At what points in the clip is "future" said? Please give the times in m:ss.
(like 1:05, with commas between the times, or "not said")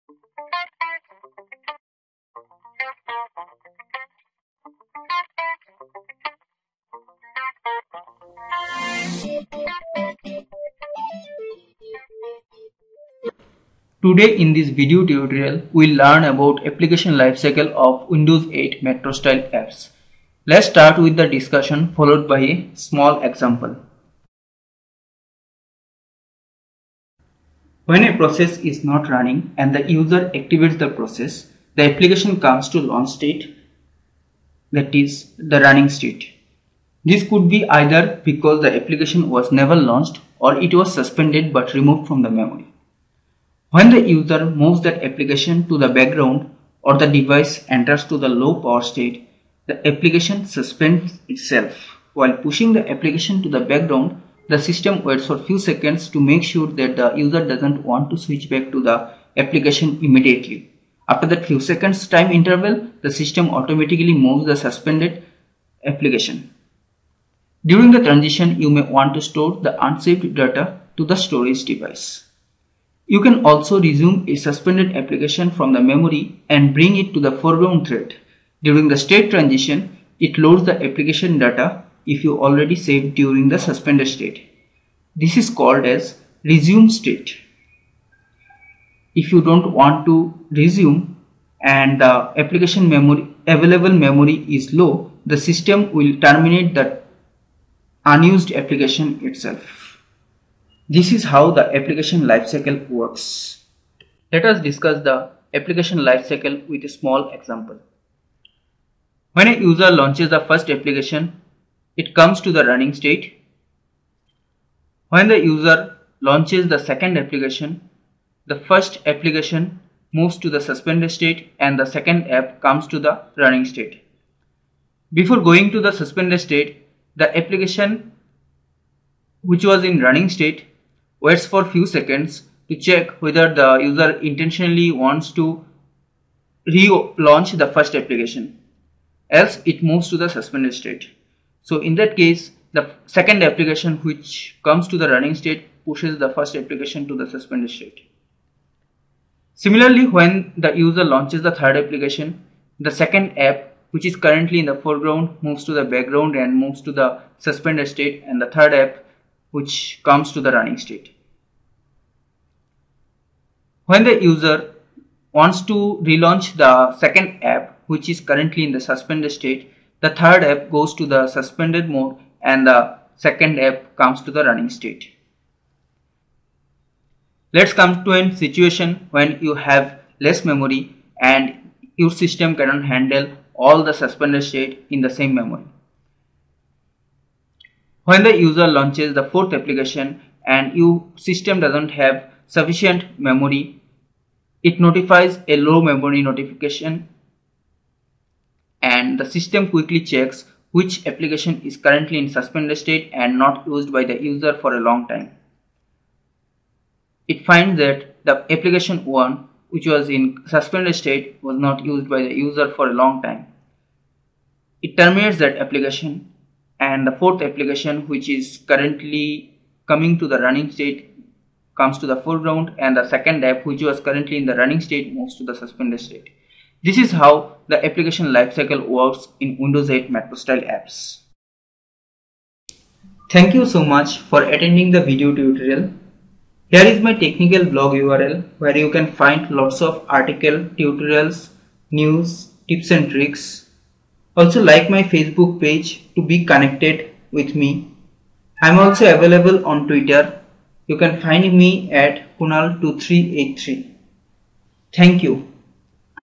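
not said.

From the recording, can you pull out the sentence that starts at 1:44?
Let us discuss the application lifecycle with a small example.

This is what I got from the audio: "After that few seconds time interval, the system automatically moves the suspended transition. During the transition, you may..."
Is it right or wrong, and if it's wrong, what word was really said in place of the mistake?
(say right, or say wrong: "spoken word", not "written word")
wrong: "application", not "transition".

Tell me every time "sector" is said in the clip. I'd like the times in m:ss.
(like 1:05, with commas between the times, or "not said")
not said.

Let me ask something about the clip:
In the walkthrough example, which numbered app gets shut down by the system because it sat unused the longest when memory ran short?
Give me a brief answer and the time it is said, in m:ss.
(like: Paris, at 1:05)
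application 1, at 3:28.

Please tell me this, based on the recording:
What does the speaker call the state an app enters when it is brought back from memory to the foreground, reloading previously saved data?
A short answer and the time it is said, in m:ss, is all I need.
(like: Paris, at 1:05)
resume state, at 1:26.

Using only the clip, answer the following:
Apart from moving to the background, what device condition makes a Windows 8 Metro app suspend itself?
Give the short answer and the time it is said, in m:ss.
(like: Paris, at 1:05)
low power state, at 0:48.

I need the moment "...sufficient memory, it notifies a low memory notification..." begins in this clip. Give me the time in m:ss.
3:12.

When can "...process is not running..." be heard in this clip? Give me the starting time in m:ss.
0:28.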